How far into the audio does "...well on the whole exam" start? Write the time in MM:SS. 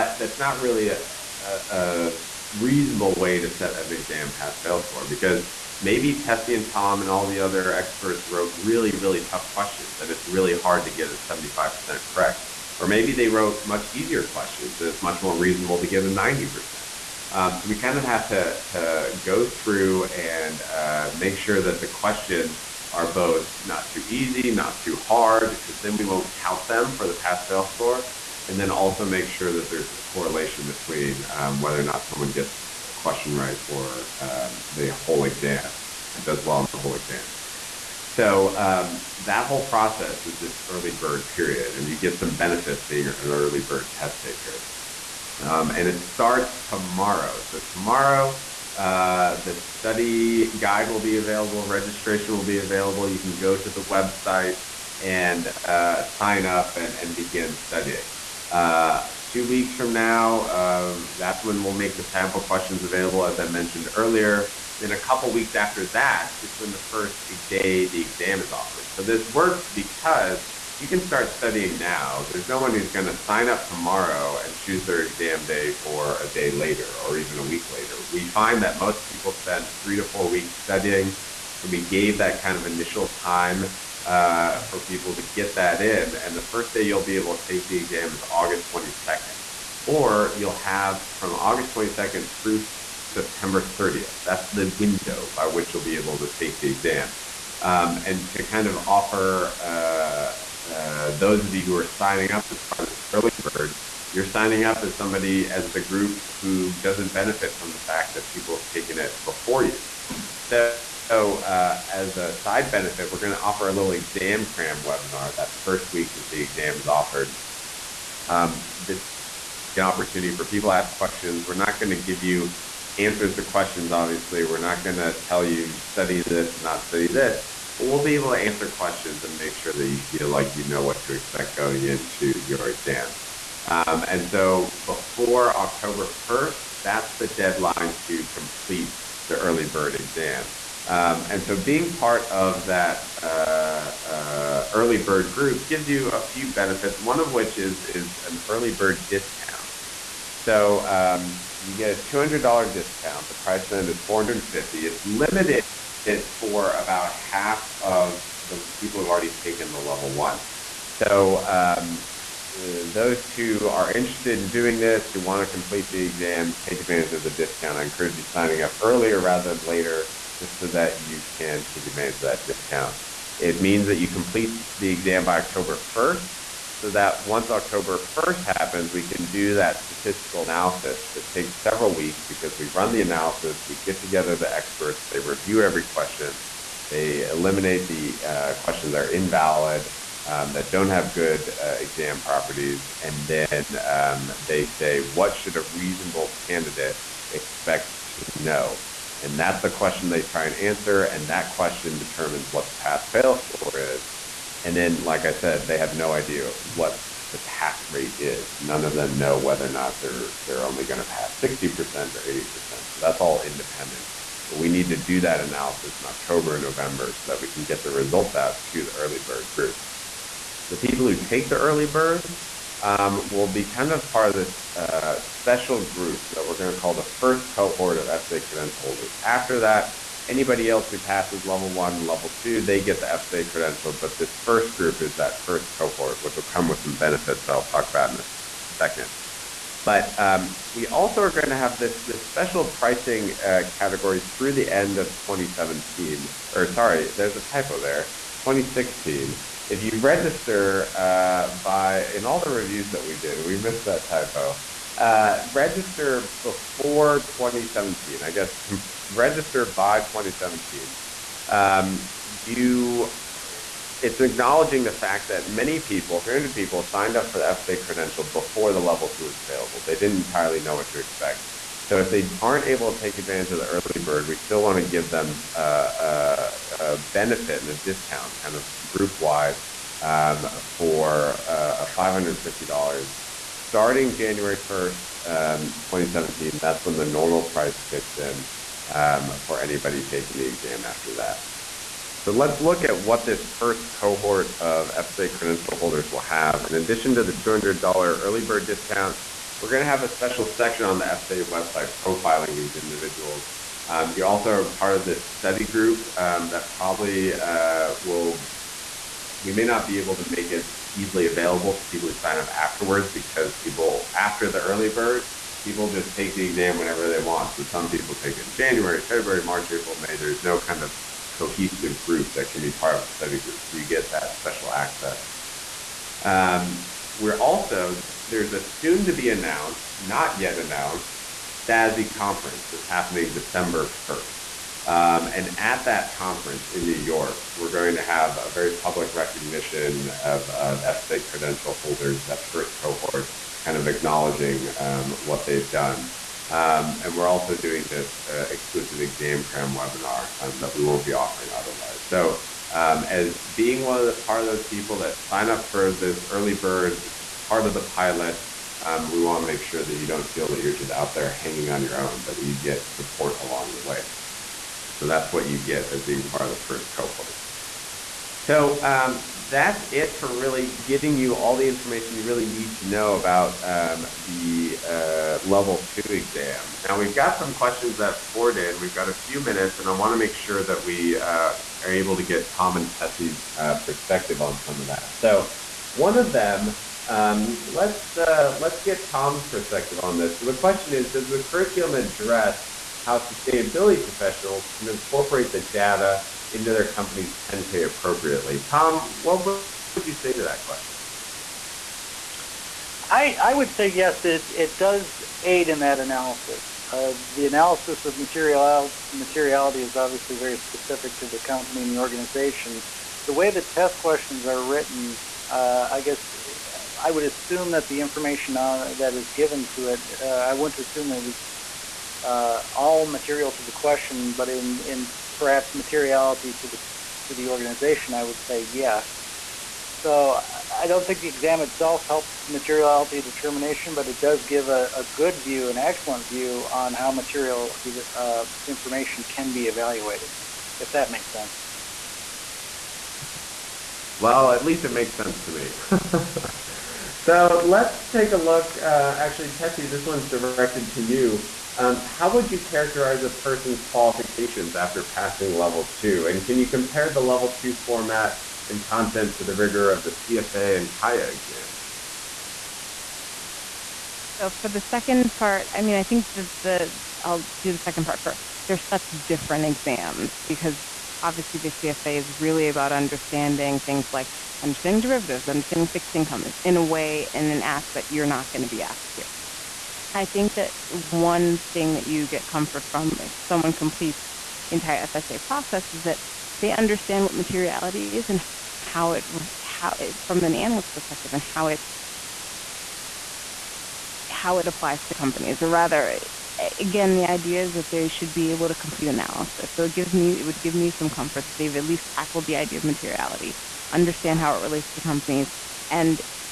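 00:36.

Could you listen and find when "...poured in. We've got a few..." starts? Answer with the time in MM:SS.
06:18.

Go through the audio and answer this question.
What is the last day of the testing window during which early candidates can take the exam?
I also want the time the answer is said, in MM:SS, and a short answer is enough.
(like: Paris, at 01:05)
September 30th, at 01:33.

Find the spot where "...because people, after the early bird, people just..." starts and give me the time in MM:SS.
05:13.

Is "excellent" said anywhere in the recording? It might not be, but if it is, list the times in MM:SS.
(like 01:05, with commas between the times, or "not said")
07:15.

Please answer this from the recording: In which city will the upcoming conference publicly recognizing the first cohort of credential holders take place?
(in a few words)
New York.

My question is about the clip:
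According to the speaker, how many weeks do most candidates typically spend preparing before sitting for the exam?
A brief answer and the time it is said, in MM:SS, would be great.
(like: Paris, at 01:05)
3 to 4 weeks, at 01:19.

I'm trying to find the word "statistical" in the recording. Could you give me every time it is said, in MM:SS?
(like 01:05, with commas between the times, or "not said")
02:59.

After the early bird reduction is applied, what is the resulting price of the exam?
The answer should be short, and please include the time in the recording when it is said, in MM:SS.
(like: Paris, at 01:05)
$450, at 02:34.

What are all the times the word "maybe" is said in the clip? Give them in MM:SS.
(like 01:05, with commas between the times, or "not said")
00:05, 00:12.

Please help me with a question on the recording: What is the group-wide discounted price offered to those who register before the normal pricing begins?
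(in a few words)
$550.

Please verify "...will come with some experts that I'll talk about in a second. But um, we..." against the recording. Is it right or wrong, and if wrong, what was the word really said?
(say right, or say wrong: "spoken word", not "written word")
wrong: "benefits", not "experts".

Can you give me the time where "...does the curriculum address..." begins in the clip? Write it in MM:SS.
06:31.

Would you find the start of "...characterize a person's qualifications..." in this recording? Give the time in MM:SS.
07:32.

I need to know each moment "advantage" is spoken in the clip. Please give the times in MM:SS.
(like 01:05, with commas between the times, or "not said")
02:46, 02:51, 04:33.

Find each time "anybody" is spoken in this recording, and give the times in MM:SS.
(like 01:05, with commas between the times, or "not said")
03:50, 04:49.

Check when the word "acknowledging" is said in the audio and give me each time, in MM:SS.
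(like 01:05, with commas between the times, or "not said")
04:24, 05:43.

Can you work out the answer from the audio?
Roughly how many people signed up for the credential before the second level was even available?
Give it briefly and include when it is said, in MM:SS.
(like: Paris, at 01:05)
300, at 04:26.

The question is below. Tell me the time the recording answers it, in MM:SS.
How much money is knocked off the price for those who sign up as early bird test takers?
02:32.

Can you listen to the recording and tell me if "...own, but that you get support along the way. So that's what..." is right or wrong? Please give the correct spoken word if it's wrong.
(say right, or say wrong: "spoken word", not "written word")
right.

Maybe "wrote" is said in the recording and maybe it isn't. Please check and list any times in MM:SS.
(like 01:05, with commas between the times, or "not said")
00:08, 00:13.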